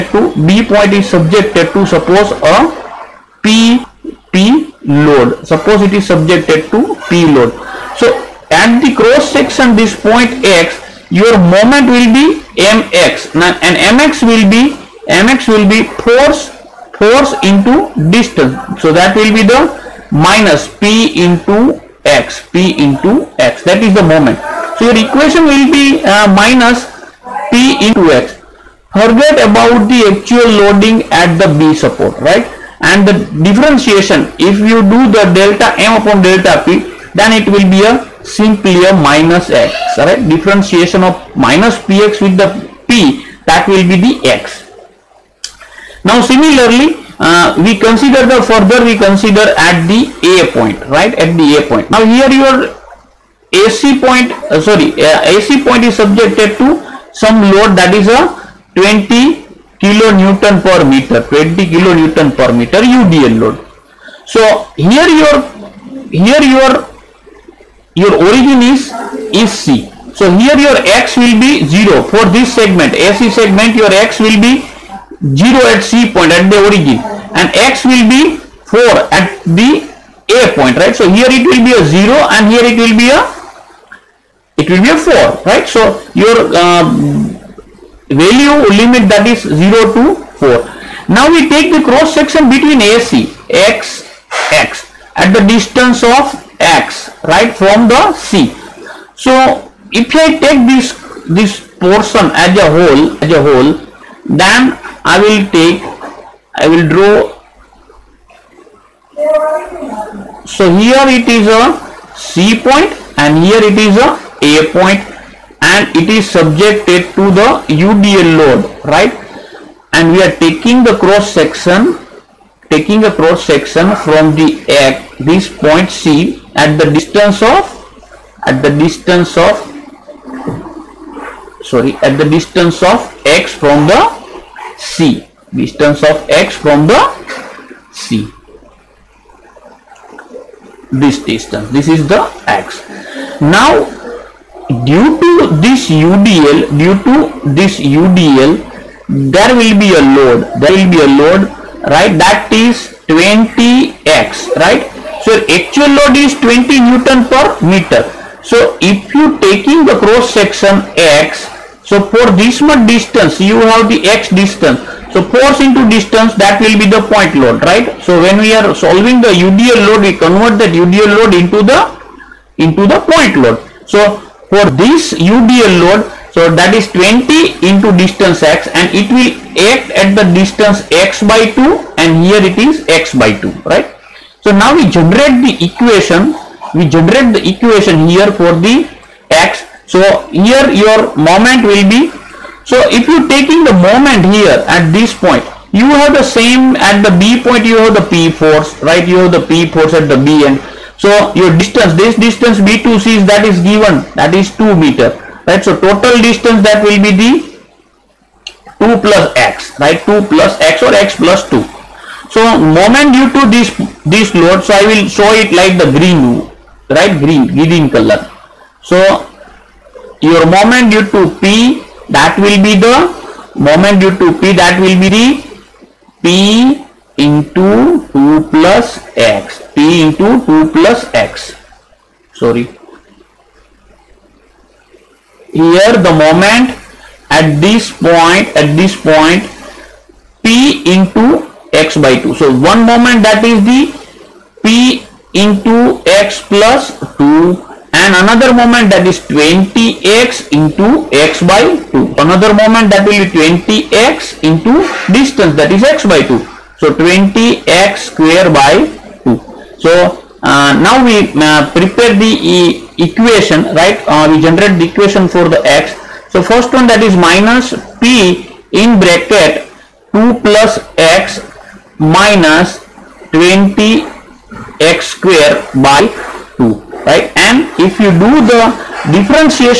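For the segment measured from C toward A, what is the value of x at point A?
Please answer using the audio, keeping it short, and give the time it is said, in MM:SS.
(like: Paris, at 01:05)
4, at 01:17.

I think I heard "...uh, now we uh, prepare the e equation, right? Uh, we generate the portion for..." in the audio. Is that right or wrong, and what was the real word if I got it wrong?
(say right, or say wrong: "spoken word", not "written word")
wrong: "equation", not "portion".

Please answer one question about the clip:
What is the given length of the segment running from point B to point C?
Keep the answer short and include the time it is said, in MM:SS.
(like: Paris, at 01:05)
2 meters, at 03:24.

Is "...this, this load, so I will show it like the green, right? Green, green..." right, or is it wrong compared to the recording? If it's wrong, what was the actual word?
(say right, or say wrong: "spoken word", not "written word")
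right.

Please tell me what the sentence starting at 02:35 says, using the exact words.
So actual load is 20 Newton per meter.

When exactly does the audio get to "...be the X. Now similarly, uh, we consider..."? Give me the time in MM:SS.
00:43.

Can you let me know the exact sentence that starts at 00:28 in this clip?
Forget about the actual loading at the B support, right?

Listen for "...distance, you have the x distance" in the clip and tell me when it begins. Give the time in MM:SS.
02:42.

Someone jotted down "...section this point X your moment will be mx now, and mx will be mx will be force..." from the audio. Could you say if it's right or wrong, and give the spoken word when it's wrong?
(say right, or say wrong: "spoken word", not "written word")
right.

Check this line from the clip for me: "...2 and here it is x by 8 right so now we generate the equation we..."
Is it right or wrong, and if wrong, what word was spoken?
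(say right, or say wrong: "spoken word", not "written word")
wrong: "2", not "8".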